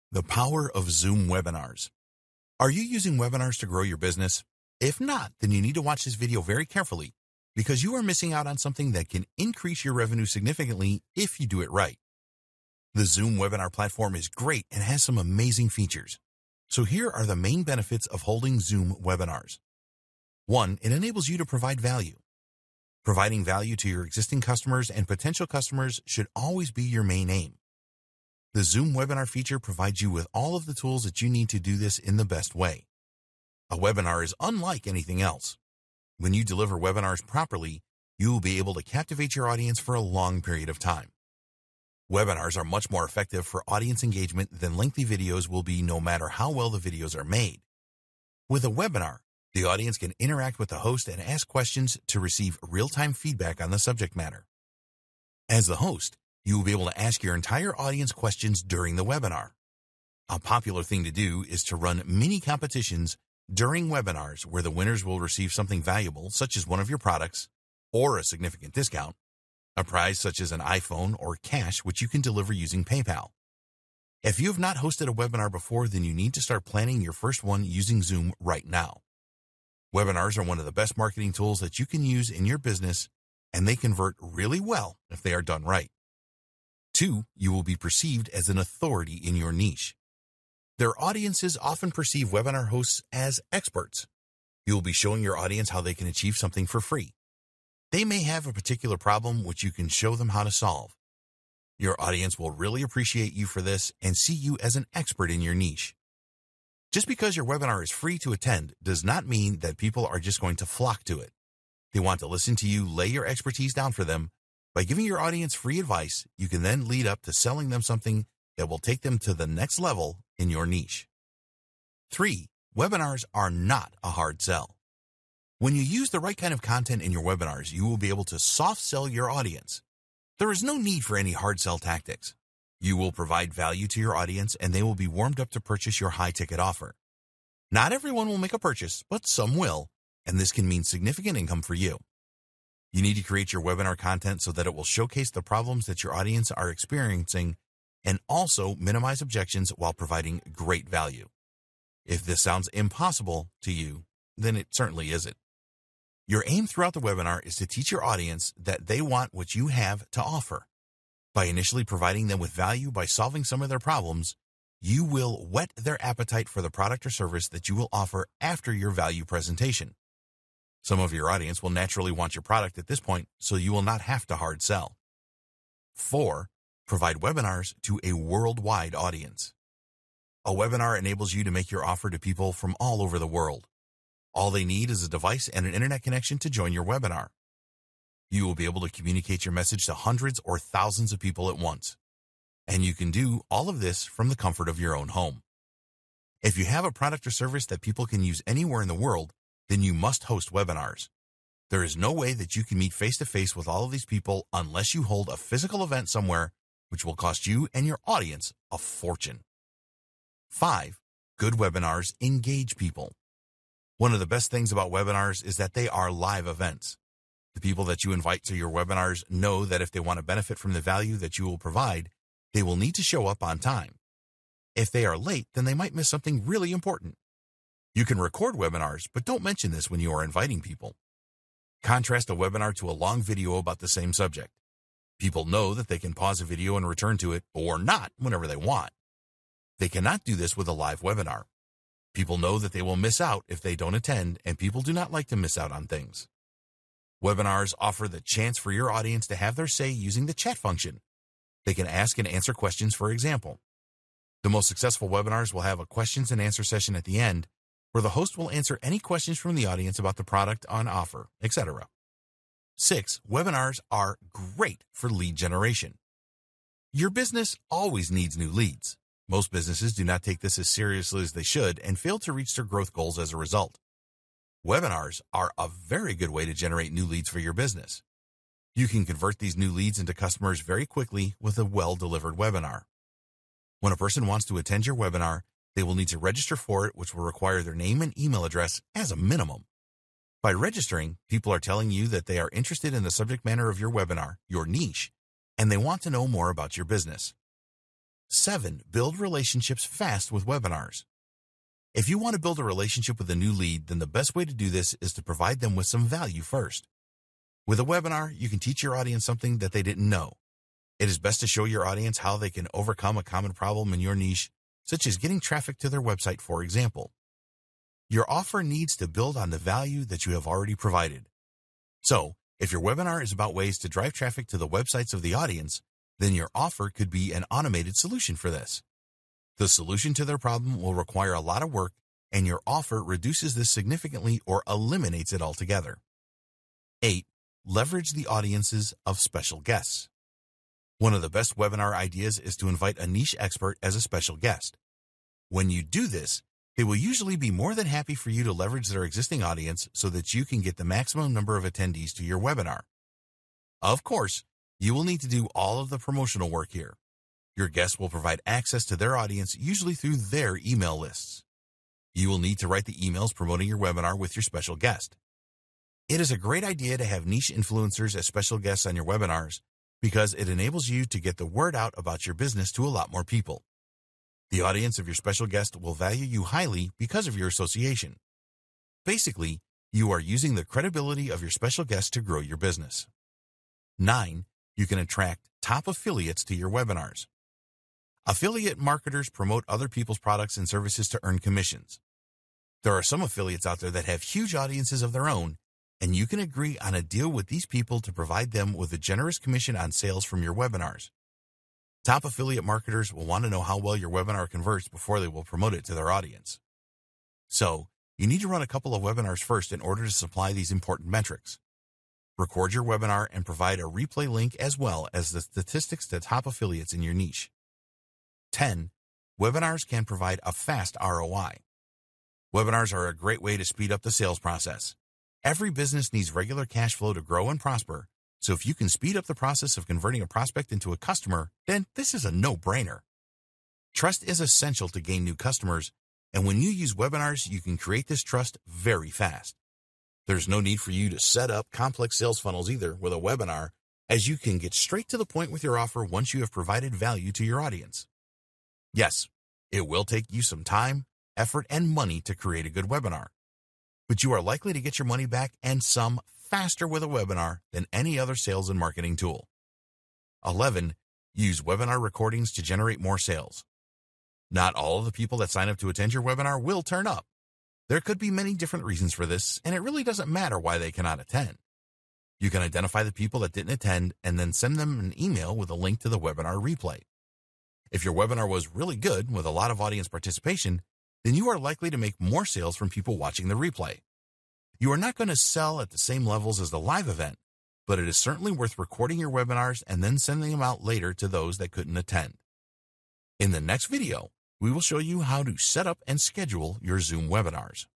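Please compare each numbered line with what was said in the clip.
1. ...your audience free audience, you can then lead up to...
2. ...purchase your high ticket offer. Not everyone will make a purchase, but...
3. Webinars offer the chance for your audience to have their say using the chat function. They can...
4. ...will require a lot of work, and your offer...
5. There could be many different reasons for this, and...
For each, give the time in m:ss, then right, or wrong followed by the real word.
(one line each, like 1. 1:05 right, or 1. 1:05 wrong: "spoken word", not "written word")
1. 1:55 wrong: "advice", not "audience"
2. 2:15 right
3. 4:07 right
4. 5:30 right
5. 7:47 right.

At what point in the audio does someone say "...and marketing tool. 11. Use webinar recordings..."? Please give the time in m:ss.
7:38.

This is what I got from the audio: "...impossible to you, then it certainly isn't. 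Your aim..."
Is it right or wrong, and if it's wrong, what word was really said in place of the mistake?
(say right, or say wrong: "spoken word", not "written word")
right.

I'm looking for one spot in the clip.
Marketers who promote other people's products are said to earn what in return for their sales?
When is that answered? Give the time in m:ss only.
6:31.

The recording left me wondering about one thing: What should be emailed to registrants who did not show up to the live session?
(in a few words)
webinar replay.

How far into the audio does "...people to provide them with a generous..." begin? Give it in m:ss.
6:37.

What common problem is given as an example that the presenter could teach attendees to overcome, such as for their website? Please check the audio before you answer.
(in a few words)
getting traffic.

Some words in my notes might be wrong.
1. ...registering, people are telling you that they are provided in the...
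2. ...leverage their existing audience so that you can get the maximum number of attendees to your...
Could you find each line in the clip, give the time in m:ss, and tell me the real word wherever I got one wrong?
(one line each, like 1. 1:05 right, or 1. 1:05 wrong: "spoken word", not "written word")
1. 4:50 wrong: "interested", not "provided"
2. 5:48 right.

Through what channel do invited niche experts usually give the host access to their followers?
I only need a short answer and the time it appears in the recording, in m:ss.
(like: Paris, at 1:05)
email lists, at 6:00.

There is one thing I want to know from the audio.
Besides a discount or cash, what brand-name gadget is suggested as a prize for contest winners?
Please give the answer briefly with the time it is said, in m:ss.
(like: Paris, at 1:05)
iPhone, at 1:10.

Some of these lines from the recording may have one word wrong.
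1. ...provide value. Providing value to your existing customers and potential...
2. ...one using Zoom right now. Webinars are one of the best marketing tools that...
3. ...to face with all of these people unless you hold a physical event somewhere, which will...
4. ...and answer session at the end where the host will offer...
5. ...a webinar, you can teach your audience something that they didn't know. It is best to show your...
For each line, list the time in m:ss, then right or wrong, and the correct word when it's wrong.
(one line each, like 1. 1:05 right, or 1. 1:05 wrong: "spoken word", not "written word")
1. 0:21 right
2. 1:17 right
3. 3:23 right
4. 4:16 wrong: "answer", not "offer"
5. 5:07 right.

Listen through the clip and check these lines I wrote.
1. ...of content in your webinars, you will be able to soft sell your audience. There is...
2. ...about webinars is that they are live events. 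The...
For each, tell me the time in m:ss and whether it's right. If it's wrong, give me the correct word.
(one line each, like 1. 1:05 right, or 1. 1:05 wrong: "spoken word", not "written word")
1. 2:06 right
2. 3:34 right.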